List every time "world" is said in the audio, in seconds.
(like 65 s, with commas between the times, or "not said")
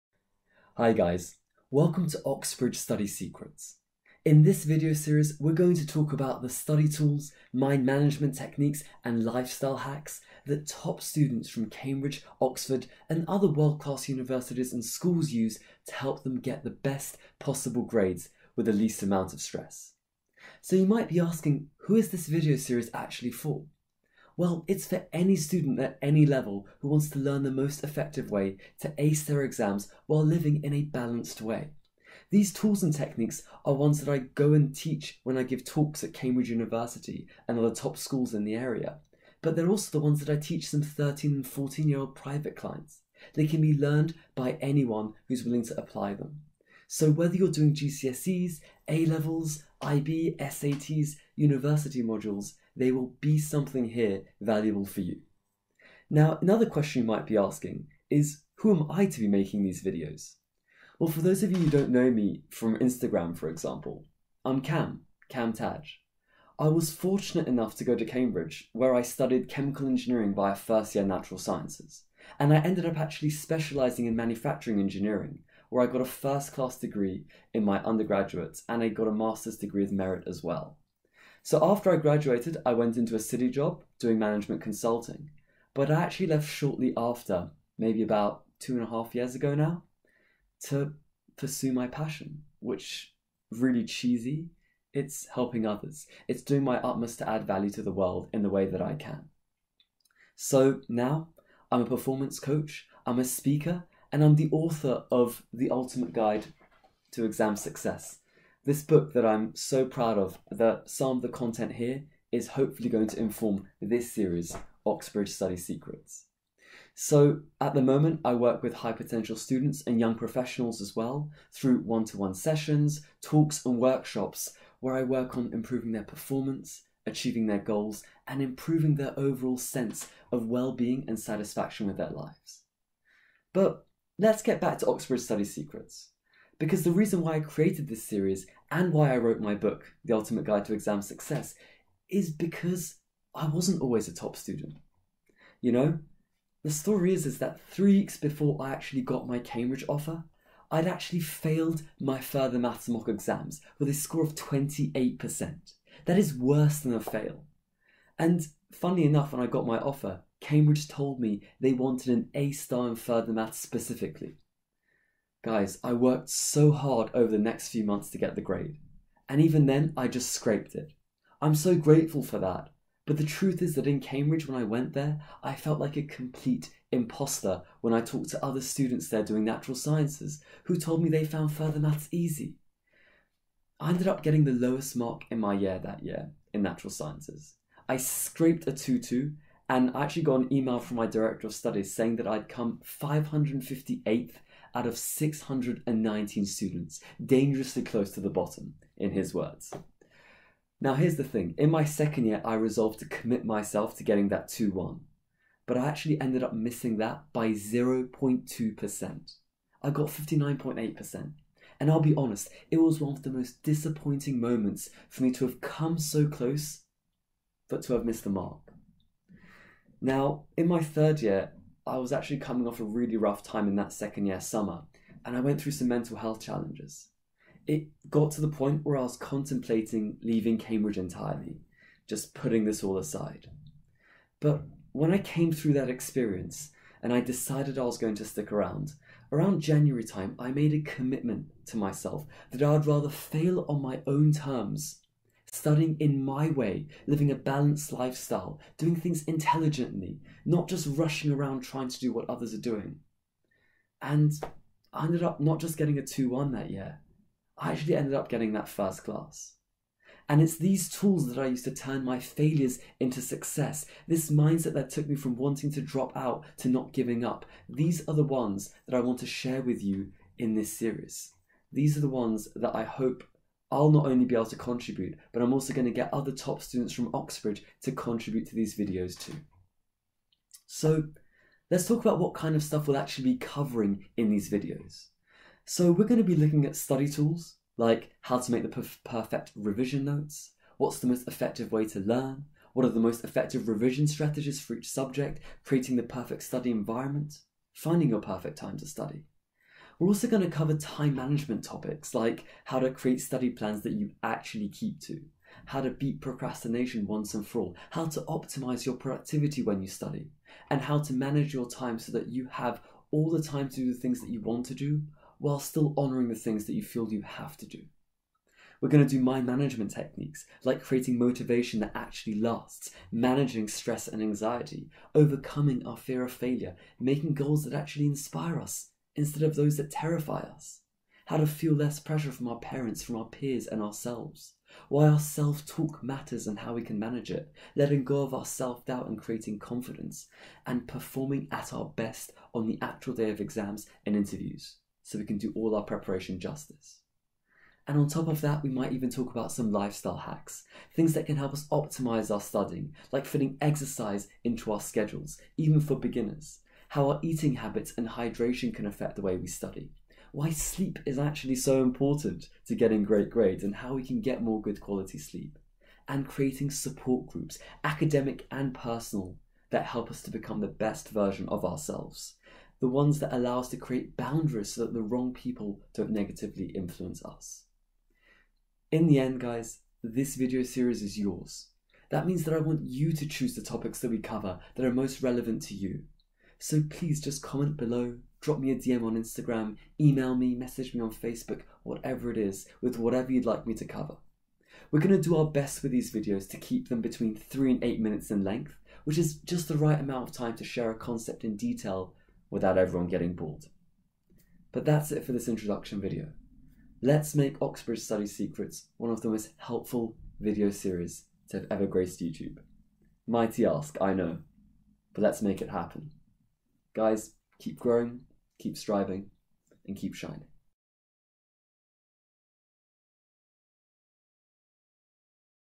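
13 s, 97 s.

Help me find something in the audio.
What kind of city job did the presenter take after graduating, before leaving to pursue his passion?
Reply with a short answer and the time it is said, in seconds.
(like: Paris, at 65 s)
Management consulting, at 84 s.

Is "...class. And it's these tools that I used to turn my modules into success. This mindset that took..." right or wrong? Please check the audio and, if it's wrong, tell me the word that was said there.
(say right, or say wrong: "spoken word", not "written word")
wrong: "failures", not "modules".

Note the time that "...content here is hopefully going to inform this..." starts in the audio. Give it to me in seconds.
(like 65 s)
111 s.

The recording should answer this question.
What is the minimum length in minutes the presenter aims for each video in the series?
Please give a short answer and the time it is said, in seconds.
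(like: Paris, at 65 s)
3, at 397 s.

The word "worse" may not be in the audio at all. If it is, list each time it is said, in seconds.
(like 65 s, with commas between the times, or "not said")
156 s.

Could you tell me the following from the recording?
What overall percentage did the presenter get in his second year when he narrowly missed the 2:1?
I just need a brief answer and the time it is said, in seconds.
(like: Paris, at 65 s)
59.8%, at 210 s.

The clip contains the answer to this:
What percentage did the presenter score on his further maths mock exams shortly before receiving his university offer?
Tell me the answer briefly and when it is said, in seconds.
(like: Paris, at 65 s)
28%, at 154 s.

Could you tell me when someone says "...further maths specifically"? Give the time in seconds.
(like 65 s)
162 s.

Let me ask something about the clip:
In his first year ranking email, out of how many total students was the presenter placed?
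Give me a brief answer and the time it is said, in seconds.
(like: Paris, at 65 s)
619, at 194 s.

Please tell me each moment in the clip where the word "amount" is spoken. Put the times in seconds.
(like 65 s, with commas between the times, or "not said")
19 s, 399 s.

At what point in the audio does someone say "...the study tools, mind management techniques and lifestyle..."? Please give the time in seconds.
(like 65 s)
6 s.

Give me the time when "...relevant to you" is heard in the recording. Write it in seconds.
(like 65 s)
385 s.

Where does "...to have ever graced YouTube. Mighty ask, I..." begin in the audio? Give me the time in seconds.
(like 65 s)
411 s.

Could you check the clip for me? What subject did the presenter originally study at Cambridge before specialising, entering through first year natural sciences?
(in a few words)
Chemical engineering.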